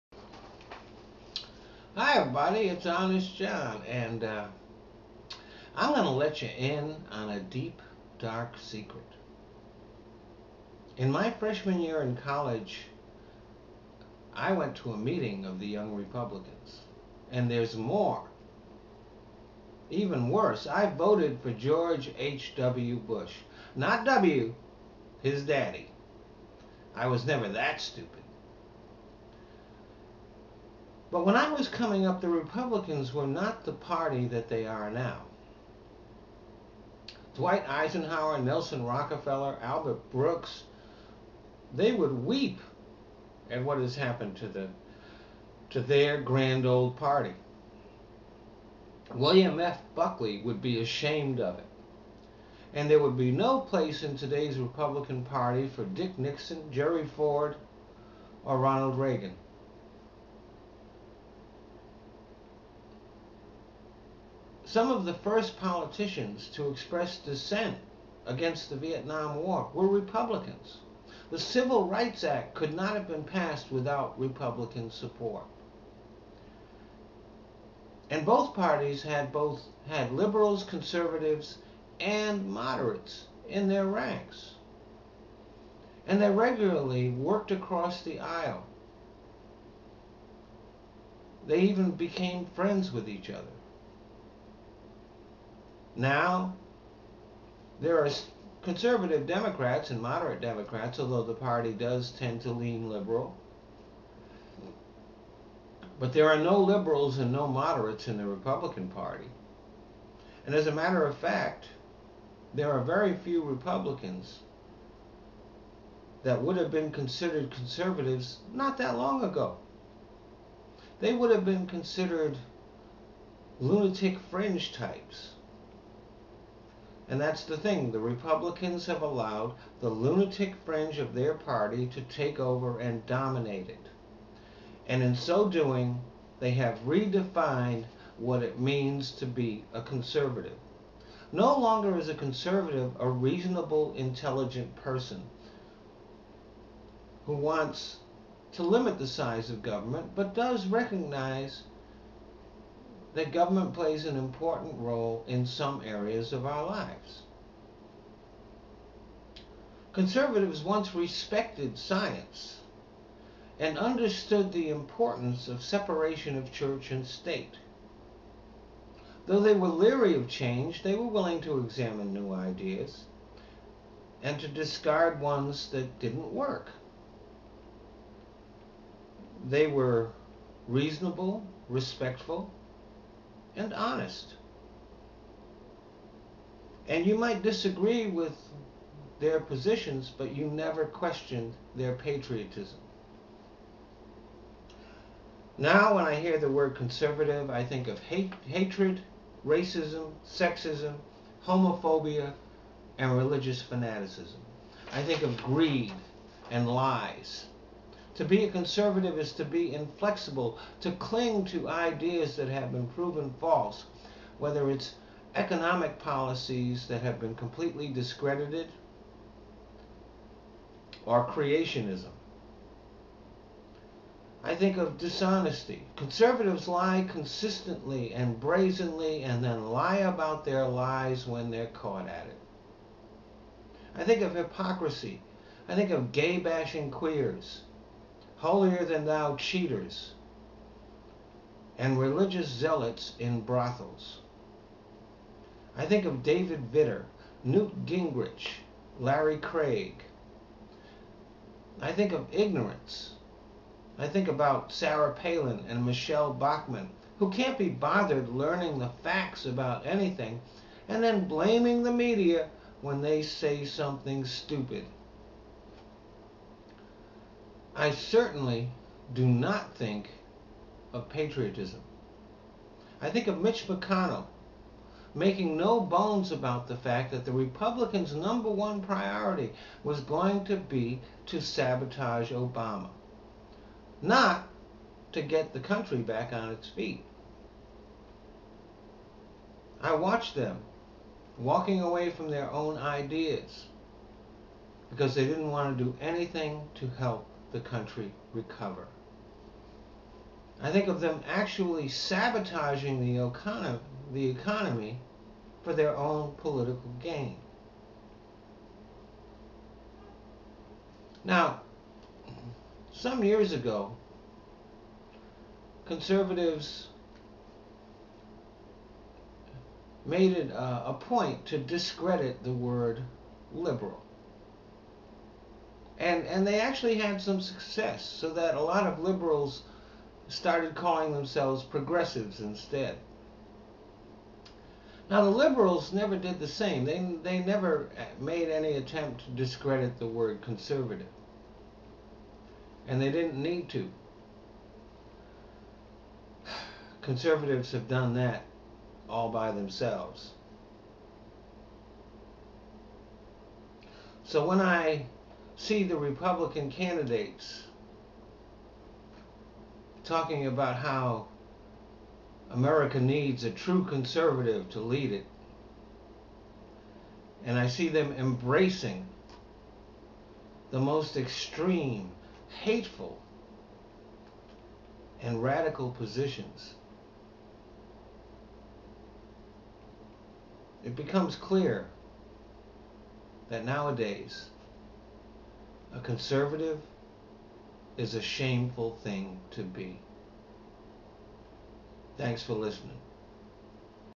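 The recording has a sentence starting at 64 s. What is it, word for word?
Some of the first politicians to express dissent against the Vietnam War were Republicans.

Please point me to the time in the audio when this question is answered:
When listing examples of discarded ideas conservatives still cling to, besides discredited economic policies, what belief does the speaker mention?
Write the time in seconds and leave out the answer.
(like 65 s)
221 s.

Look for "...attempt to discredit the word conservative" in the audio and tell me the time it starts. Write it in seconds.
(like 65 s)
338 s.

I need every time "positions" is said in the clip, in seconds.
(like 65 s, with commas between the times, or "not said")
189 s, 375 s.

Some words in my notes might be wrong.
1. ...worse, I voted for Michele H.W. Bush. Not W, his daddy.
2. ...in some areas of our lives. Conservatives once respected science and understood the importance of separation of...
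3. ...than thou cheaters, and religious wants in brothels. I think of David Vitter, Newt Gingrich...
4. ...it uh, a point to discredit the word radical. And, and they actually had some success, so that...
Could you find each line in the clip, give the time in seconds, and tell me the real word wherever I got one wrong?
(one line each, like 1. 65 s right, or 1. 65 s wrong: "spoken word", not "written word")
1. 20 s wrong: "George", not "Michele"
2. 155 s right
3. 238 s wrong: "zealots", not "wants"
4. 320 s wrong: "liberal", not "radical".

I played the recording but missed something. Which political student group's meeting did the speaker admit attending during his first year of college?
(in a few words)
Young Republicans.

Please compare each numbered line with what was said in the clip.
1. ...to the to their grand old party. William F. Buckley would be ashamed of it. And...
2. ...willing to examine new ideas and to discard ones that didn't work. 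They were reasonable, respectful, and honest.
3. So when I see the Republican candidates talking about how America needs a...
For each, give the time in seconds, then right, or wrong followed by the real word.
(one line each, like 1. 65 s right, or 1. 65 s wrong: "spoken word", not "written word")
1. 44 s right
2. 171 s right
3. 354 s right.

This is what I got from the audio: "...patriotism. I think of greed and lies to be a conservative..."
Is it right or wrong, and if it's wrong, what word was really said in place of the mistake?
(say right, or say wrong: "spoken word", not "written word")
wrong: "fanaticism", not "patriotism".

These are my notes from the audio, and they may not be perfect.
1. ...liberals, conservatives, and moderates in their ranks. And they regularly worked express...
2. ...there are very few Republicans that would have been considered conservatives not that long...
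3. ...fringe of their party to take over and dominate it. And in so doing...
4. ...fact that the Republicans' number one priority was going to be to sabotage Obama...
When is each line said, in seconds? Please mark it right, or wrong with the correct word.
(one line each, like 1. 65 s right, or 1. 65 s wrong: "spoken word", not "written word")
1. 80 s wrong: "across", not "express"
2. 112 s right
3. 130 s right
4. 276 s right.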